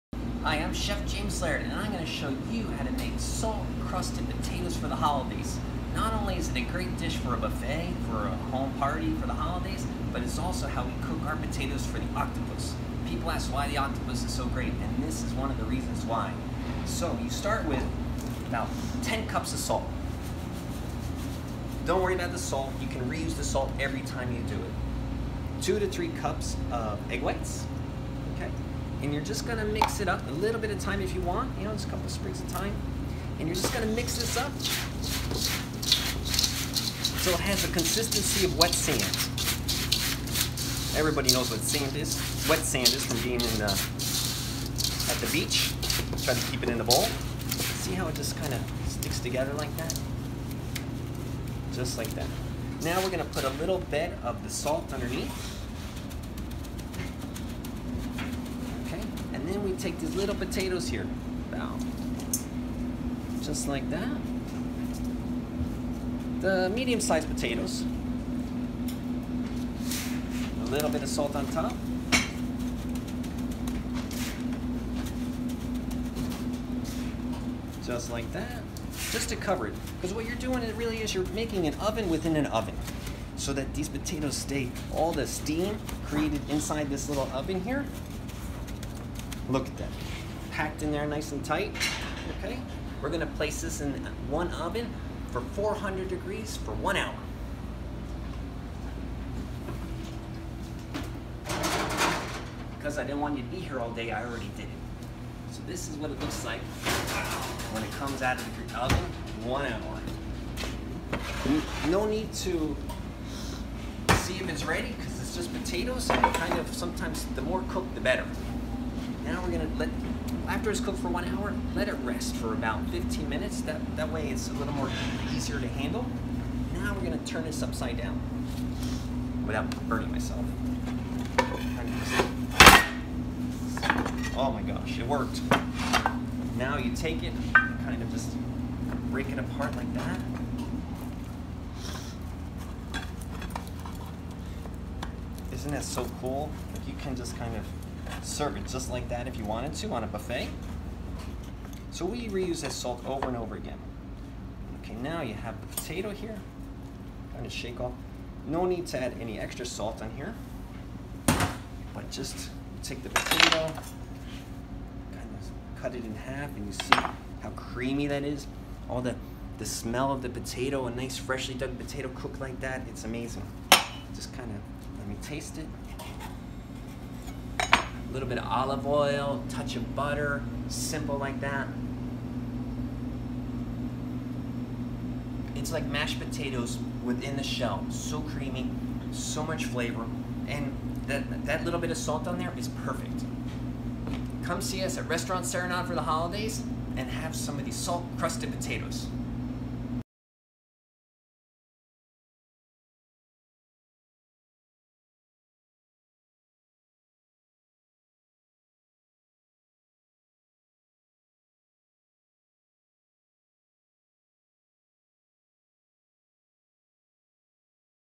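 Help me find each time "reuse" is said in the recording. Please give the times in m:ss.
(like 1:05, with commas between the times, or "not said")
0:23, 2:32.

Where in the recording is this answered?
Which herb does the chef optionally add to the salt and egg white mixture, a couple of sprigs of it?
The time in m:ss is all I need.
0:32.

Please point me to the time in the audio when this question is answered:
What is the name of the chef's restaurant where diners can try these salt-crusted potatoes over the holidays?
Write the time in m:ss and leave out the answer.
3:15.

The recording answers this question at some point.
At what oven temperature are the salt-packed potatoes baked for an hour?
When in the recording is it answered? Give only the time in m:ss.
1:35.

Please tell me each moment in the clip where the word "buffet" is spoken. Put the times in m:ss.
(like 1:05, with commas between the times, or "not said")
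0:07, 2:30.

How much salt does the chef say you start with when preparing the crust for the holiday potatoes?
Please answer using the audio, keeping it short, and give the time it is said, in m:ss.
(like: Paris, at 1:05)
10 cups, at 0:19.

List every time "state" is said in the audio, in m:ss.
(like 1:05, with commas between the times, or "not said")
not said.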